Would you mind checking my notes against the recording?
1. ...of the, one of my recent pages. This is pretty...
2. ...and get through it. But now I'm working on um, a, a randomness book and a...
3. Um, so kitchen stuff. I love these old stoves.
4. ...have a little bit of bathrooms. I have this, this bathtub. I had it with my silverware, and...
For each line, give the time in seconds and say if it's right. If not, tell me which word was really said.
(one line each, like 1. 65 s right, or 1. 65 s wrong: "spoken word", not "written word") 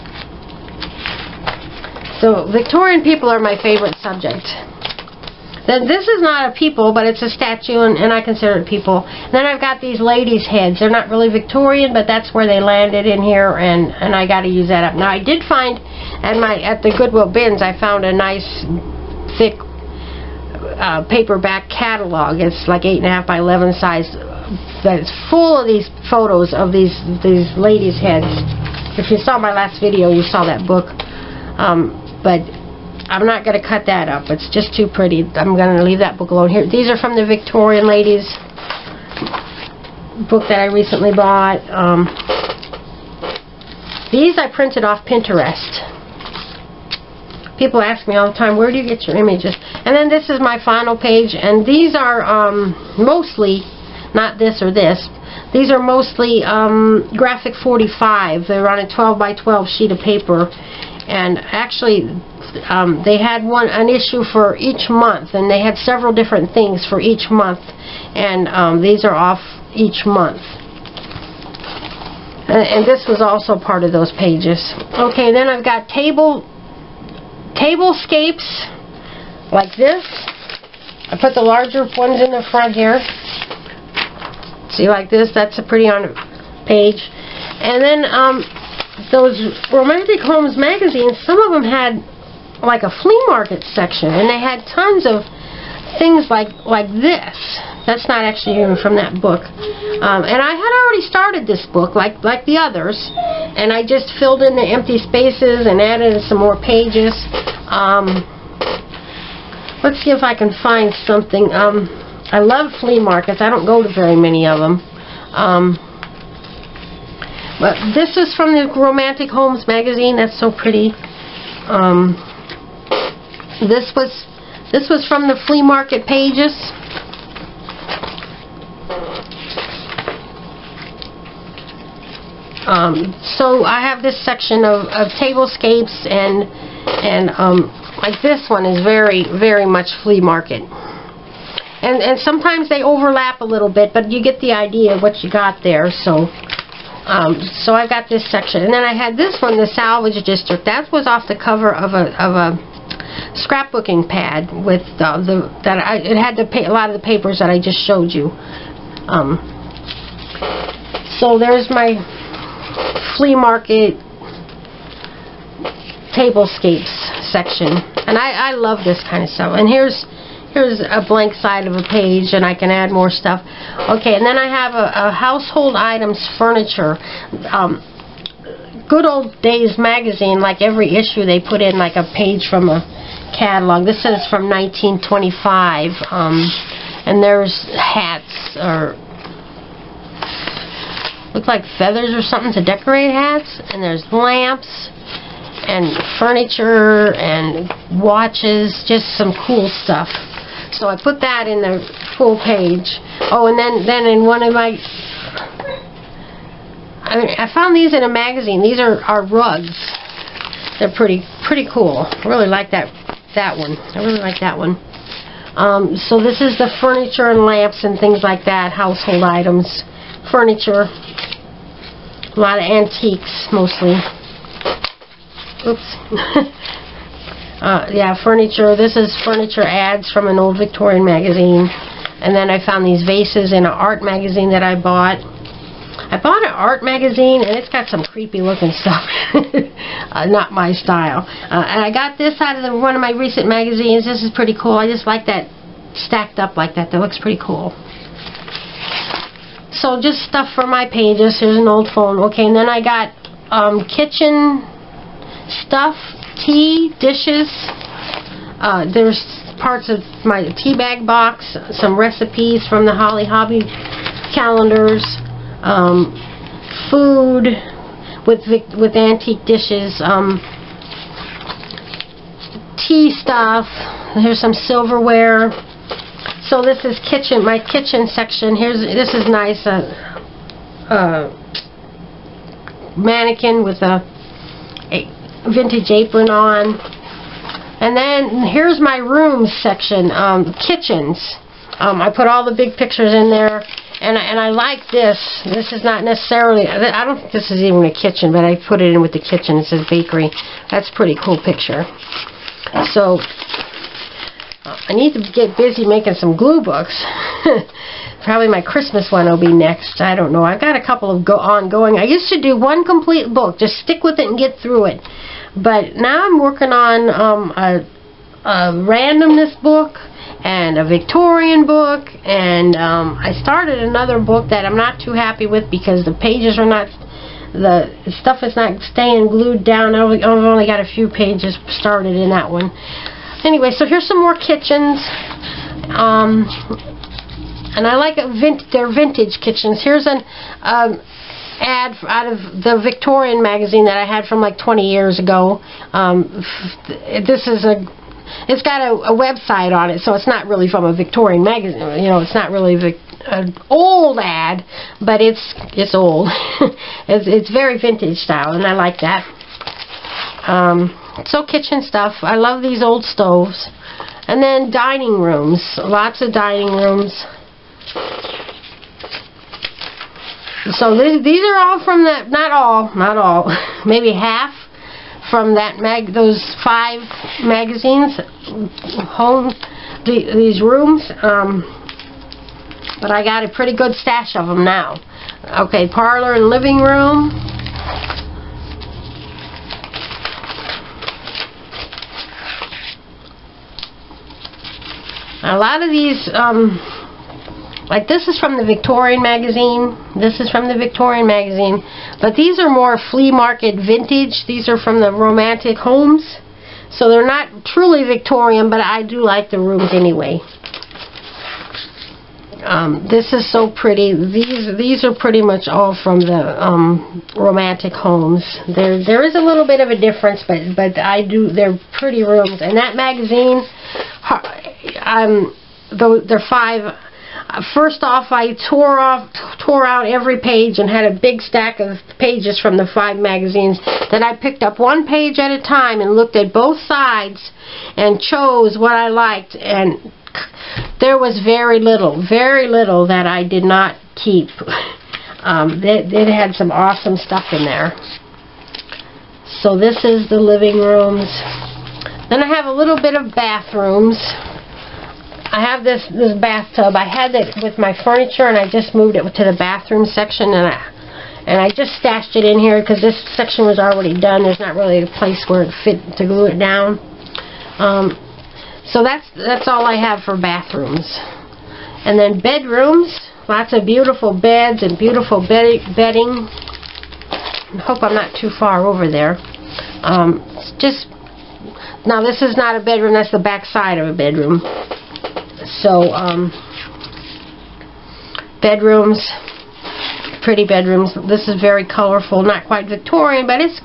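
1. 242 s wrong: "magazines", not "pages"
2. 314 s right
3. 360 s right
4. 452 s wrong: "furniture", not "silverware".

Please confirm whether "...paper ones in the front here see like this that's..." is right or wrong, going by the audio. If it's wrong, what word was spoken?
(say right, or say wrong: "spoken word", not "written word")
wrong: "larger", not "paper".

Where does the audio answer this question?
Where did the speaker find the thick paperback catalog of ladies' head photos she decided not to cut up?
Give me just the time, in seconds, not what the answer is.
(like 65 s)
16 s.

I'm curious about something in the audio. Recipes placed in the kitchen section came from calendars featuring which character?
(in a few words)
Holly Hobbie.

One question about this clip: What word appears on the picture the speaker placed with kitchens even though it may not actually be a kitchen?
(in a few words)
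bakery.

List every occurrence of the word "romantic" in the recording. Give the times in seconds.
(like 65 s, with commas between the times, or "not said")
89 s, 118 s, 405 s, 417 s.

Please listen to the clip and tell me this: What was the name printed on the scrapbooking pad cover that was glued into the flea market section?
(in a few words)
Salvage District.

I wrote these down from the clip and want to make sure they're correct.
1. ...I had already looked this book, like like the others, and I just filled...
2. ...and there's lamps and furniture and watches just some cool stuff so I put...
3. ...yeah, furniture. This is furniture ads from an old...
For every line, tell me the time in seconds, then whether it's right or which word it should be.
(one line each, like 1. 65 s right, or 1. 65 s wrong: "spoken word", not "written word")
1. 100 s wrong: "started", not "looked"
2. 193 s right
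3. 227 s right.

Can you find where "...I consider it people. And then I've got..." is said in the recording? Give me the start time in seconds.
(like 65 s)
8 s.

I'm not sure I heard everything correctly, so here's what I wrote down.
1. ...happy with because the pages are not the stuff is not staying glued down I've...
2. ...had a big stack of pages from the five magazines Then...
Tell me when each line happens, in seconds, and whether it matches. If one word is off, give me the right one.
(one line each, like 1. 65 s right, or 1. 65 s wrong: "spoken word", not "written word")
1. 325 s right
2. 430 s right.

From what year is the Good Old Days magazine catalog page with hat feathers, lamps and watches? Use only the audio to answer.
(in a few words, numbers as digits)
1925.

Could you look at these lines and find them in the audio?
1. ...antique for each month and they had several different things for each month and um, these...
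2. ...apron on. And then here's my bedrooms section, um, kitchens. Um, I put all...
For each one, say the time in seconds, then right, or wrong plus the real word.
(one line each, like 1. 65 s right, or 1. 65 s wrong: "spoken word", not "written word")
1. 63 s wrong: "issue", not "antique"
2. 285 s wrong: "rooms", not "bedrooms".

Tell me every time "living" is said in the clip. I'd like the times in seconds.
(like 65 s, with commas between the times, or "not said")
386 s, 450 s.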